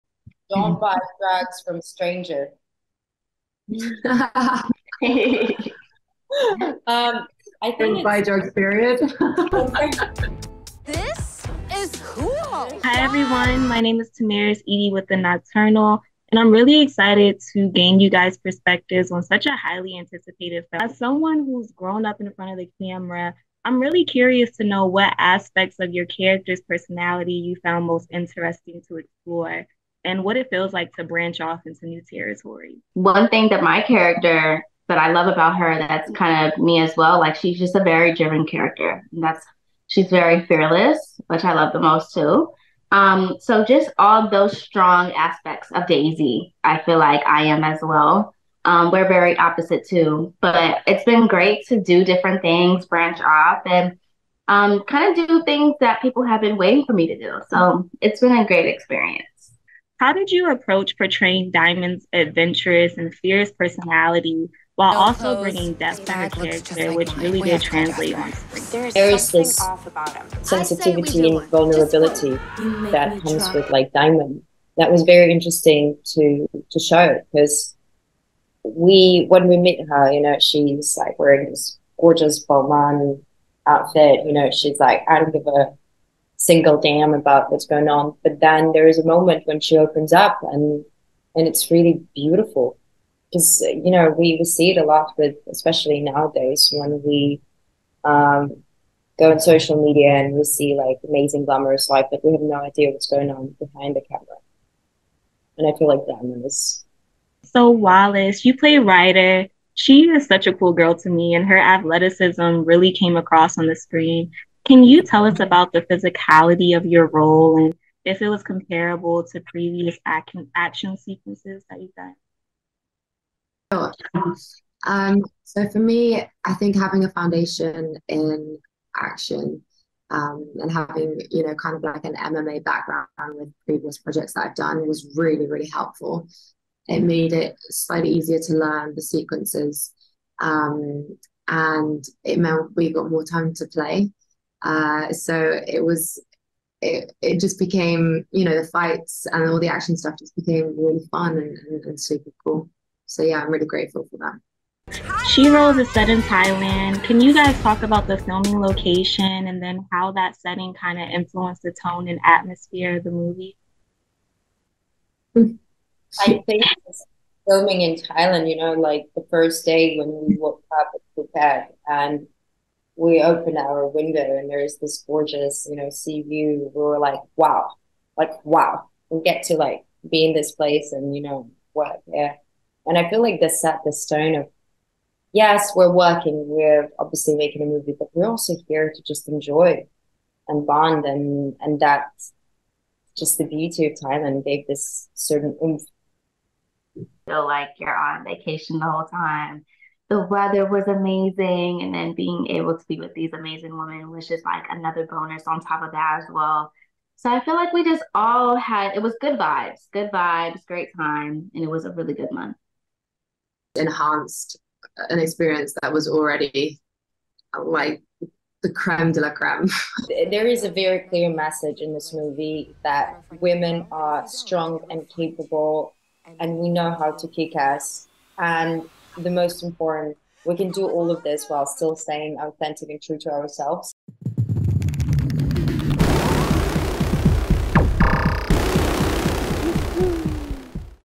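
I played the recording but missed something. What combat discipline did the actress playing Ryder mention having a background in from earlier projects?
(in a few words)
MMA.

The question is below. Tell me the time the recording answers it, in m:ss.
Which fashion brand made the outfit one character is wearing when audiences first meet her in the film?
1:22.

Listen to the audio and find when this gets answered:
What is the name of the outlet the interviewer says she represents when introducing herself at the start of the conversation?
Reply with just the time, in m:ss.
0:15.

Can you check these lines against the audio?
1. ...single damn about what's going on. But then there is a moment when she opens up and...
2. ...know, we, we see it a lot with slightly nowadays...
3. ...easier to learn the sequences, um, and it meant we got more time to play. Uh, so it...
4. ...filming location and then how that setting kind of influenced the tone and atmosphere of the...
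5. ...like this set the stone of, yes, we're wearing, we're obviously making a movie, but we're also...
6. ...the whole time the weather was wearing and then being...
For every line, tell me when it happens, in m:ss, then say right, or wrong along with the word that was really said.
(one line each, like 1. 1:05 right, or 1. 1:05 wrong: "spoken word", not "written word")
1. 1:26 right
2. 1:33 wrong: "especially", not "slightly"
3. 2:18 right
4. 2:38 right
5. 3:03 wrong: "working", not "wearing"
6. 3:18 wrong: "amazing", not "wearing".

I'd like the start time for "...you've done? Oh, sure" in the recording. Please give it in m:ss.
2:01.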